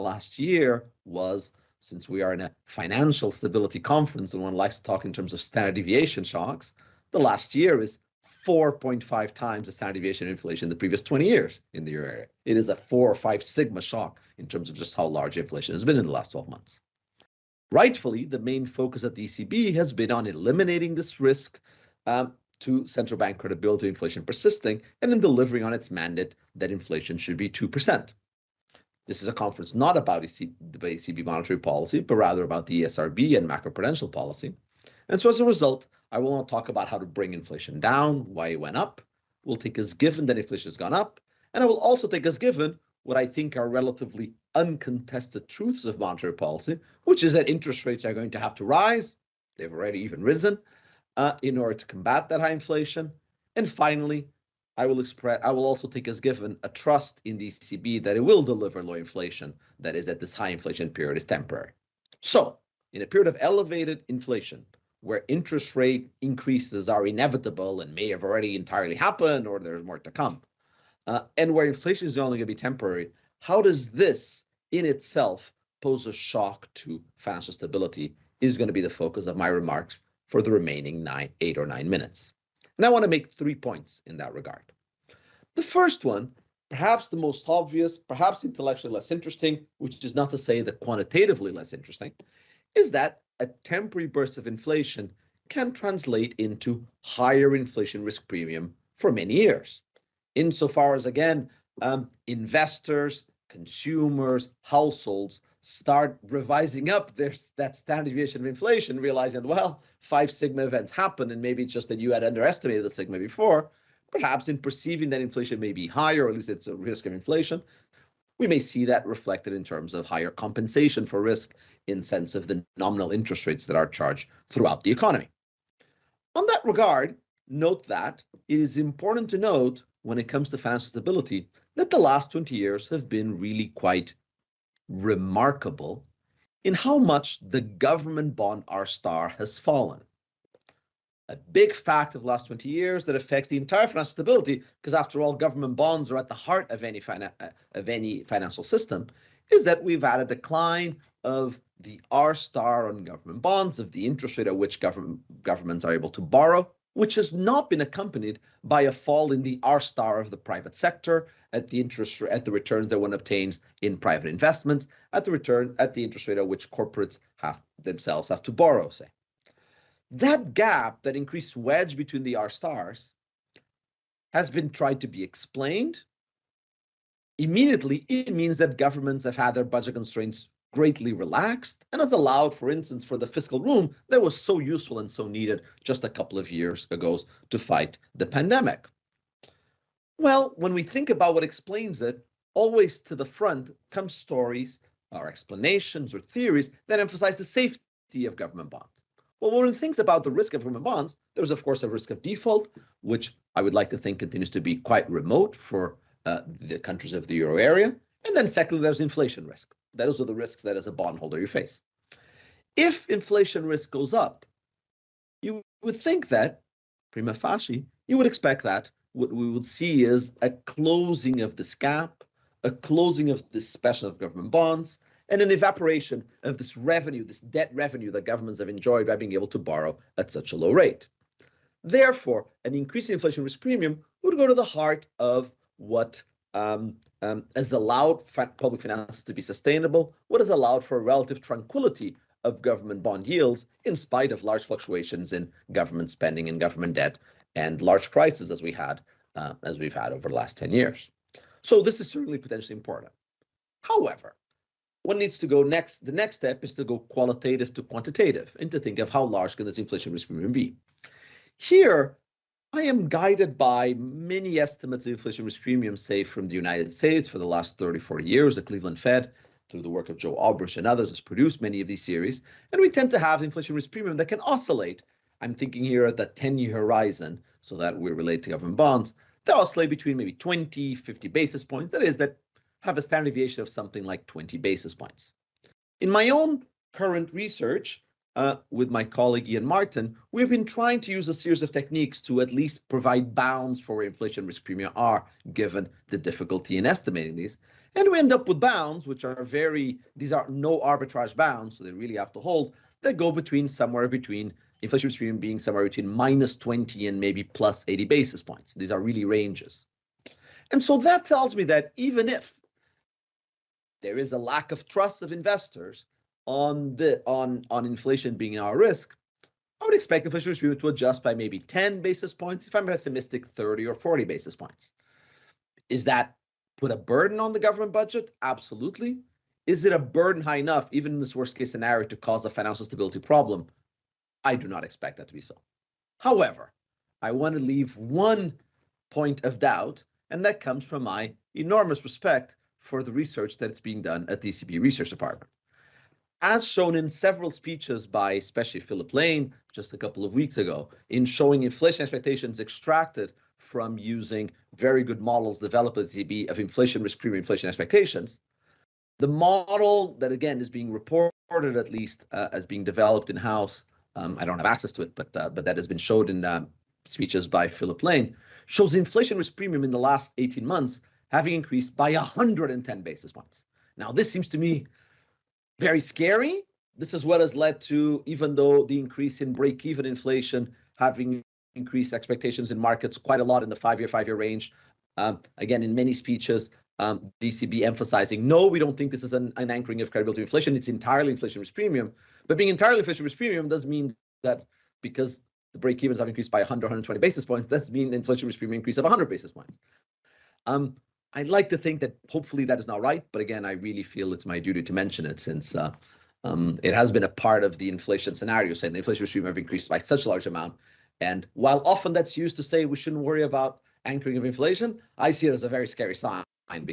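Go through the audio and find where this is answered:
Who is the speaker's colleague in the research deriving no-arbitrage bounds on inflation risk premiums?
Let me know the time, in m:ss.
4:49.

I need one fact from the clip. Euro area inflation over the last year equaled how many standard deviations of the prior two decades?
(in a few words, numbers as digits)
4.5.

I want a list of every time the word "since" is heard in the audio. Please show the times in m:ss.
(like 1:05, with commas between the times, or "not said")
0:01, 6:45.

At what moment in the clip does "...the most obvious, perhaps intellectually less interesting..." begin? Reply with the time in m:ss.
1:27.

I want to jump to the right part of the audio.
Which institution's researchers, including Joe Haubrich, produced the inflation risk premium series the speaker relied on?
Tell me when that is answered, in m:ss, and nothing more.
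4:28.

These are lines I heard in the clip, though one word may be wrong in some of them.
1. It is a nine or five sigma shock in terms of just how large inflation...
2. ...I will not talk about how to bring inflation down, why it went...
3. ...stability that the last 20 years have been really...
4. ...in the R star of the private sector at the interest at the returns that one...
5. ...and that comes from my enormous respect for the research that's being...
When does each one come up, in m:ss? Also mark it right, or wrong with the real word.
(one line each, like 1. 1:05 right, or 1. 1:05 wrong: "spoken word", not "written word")
1. 0:12 wrong: "four", not "nine"
2. 0:36 right
3. 2:10 right
4. 2:39 right
5. 5:40 right.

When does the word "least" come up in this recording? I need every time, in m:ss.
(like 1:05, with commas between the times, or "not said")
1:56, 4:52, 6:01.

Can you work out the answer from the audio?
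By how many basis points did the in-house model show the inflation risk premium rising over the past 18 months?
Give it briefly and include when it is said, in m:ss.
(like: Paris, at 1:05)
110, at 6:12.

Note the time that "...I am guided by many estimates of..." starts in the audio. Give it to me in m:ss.
4:22.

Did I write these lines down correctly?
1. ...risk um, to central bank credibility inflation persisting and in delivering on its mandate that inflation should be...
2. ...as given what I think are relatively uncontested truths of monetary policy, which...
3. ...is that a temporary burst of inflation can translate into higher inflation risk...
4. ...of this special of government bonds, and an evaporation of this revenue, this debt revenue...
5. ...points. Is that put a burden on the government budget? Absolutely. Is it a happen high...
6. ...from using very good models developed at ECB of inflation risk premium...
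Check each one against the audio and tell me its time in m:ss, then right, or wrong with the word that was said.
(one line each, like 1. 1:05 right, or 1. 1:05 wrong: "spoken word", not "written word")
1. 0:21 right
2. 0:42 right
3. 1:32 right
4. 3:43 right
5. 5:24 wrong: "burden", not "happen"
6. 5:53 right.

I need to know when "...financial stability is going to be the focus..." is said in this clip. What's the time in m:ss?
1:17.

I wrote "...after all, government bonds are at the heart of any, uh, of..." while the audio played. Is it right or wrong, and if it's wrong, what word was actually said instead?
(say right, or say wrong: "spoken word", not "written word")
right.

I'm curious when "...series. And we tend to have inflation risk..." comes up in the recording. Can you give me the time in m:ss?
4:32.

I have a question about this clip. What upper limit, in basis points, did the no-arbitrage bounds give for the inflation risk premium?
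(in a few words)
80 basis points.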